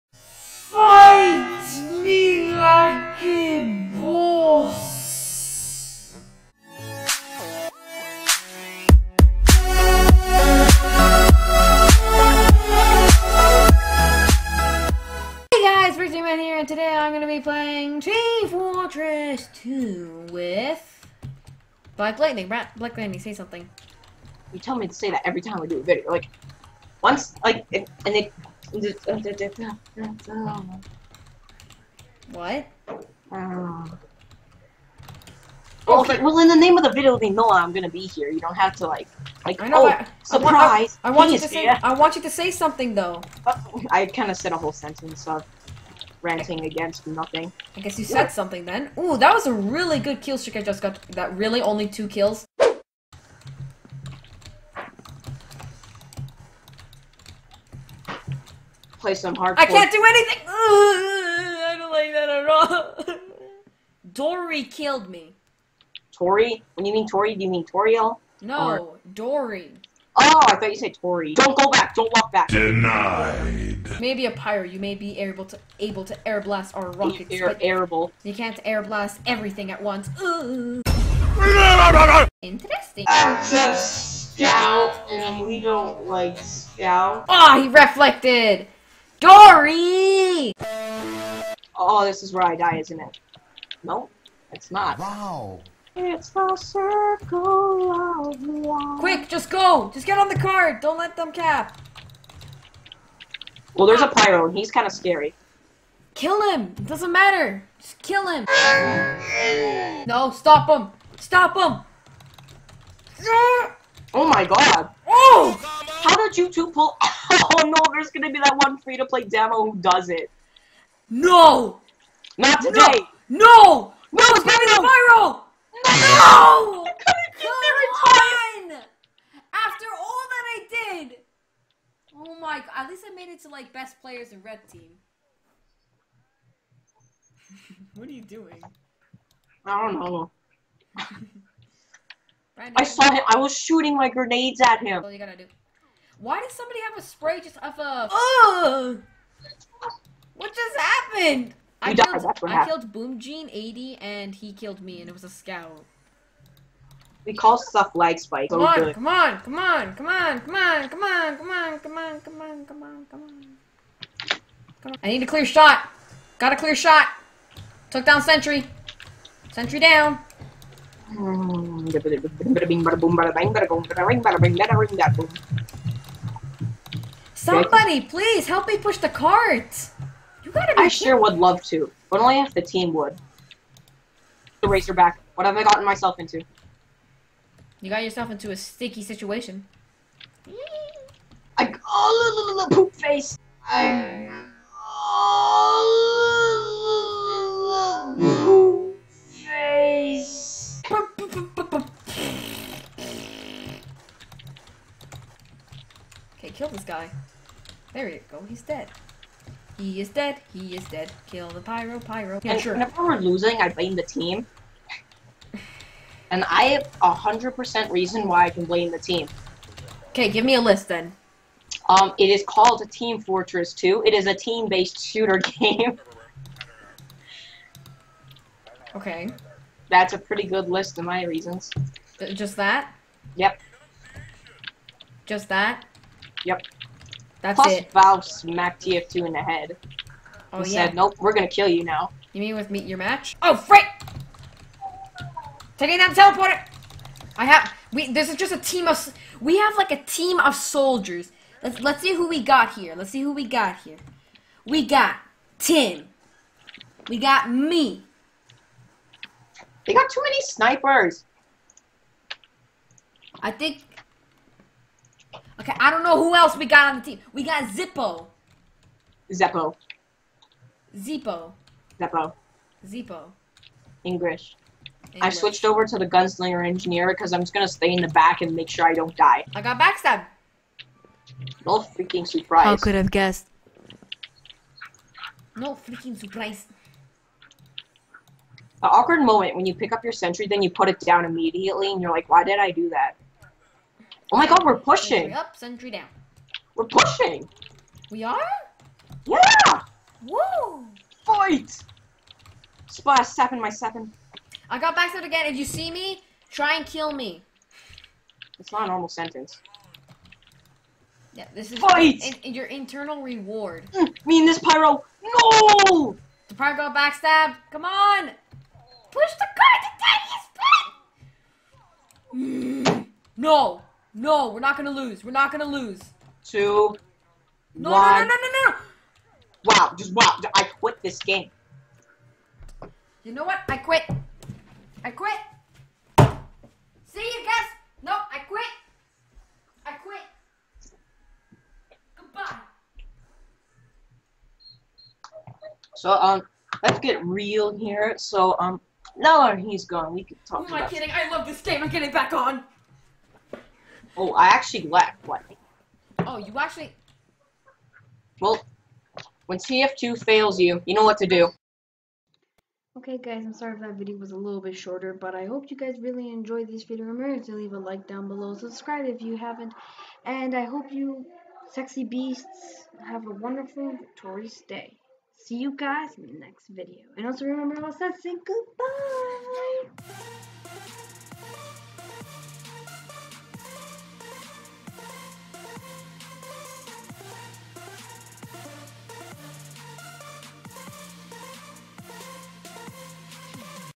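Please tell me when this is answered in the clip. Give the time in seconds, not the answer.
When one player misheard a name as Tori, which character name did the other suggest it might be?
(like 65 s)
67 s.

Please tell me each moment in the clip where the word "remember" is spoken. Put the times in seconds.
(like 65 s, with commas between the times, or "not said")
367 s, 377 s.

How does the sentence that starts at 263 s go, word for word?
I think Okay, I don't know who else we got on the team.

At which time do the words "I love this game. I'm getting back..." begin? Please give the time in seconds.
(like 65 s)
351 s.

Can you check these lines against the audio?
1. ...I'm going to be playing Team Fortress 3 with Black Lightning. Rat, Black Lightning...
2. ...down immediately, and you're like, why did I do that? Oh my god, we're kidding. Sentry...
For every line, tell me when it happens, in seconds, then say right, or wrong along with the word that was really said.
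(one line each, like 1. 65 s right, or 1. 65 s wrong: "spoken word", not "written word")
1. 16 s wrong: "2", not "3"
2. 291 s wrong: "pushing", not "kidding".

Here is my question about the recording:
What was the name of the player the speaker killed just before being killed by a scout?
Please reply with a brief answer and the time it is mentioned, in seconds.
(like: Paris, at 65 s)
Boom Gene 80, at 152 s.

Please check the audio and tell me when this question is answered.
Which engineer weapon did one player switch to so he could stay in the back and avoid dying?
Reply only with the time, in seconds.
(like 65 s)
276 s.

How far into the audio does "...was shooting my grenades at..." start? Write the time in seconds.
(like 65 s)
143 s.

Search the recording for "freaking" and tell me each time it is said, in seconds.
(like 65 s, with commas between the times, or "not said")
281 s, 285 s.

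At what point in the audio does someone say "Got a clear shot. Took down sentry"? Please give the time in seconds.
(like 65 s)
166 s.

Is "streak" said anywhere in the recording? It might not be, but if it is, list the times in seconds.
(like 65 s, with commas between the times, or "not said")
50 s.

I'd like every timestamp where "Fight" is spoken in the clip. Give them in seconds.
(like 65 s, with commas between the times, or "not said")
301 s, 311 s.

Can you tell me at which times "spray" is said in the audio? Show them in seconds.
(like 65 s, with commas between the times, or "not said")
147 s.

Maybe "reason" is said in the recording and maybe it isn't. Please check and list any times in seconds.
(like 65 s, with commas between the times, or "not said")
217 s, 231 s.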